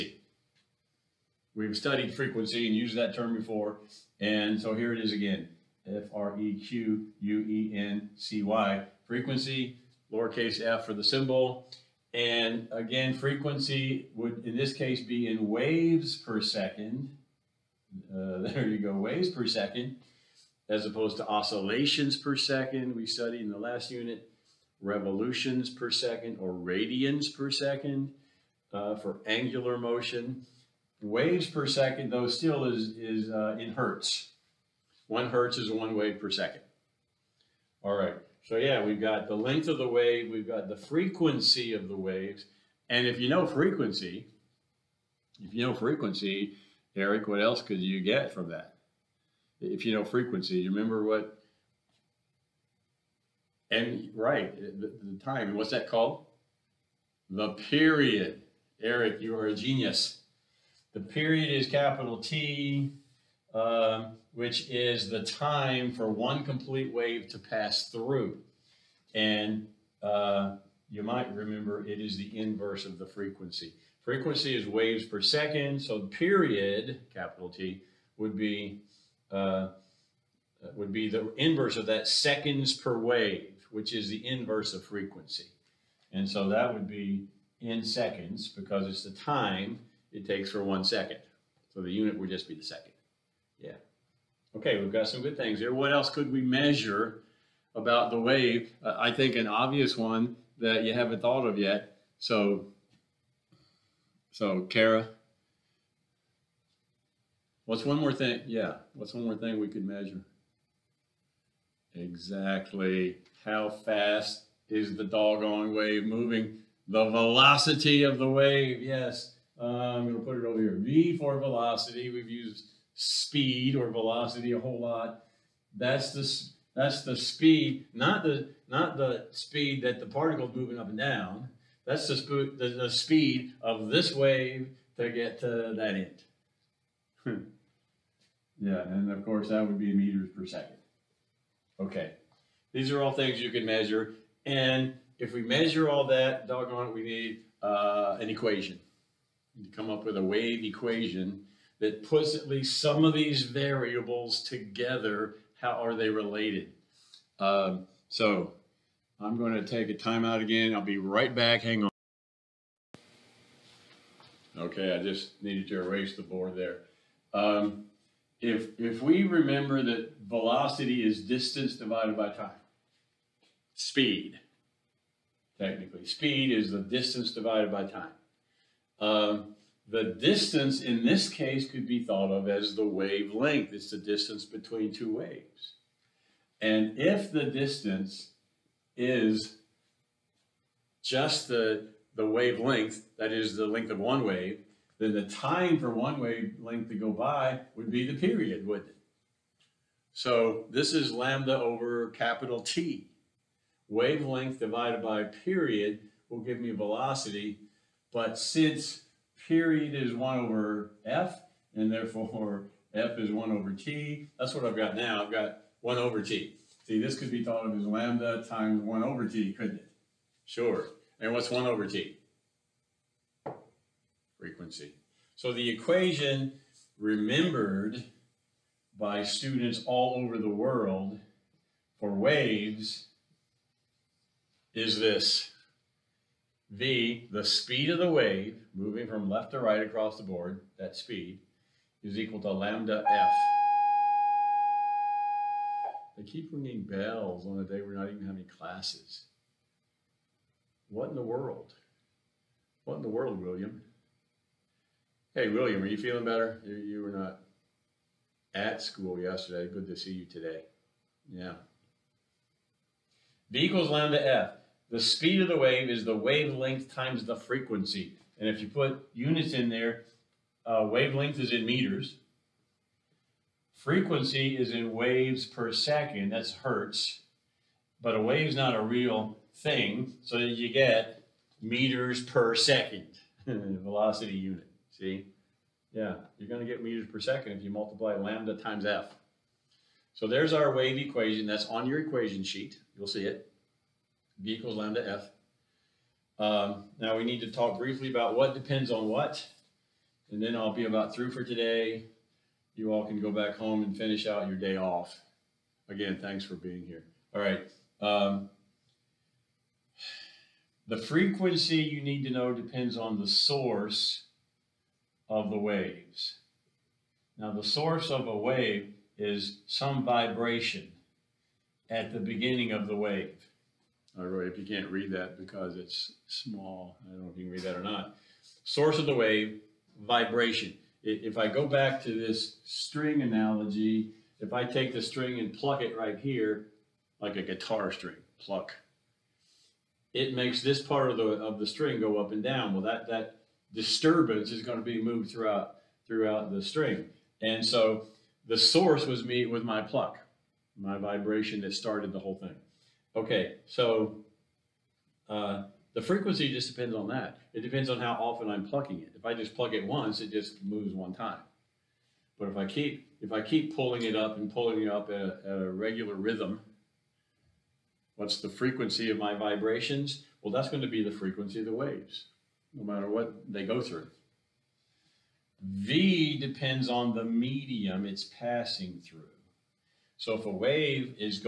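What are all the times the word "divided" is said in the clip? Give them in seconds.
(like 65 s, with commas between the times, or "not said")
171 s, 177 s, 204 s.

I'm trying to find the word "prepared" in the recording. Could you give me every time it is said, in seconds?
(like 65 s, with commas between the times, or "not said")
not said.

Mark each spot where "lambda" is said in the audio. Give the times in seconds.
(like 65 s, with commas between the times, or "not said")
201 s, 217 s, 242 s, 263 s, 288 s, 294 s.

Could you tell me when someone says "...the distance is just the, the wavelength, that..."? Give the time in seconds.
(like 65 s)
187 s.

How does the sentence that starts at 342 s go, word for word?
Well, that that disturbance is going to be moved throughout throughout the string.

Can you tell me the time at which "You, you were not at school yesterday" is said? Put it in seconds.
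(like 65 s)
256 s.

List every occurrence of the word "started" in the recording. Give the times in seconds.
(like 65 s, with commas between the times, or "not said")
351 s.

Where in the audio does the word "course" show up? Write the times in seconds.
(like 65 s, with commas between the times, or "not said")
139 s.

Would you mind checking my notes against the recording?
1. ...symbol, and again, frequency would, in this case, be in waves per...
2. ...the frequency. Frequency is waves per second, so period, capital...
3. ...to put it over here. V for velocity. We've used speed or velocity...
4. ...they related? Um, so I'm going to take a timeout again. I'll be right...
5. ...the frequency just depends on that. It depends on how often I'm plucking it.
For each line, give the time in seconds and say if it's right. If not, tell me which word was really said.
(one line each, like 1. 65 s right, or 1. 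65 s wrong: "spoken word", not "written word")
1. 11 s right
2. 72 s right
3. 120 s right
4. 155 s right
5. 355 s right.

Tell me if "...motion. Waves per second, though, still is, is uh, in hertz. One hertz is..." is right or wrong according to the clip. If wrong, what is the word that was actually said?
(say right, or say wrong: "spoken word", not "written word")
right.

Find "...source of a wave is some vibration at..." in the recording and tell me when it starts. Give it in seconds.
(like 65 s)
317 s.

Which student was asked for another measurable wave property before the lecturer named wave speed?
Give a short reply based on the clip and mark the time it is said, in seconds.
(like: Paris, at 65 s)
Kara, at 104 s.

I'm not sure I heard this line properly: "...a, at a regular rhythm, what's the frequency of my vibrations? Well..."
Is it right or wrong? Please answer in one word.
right.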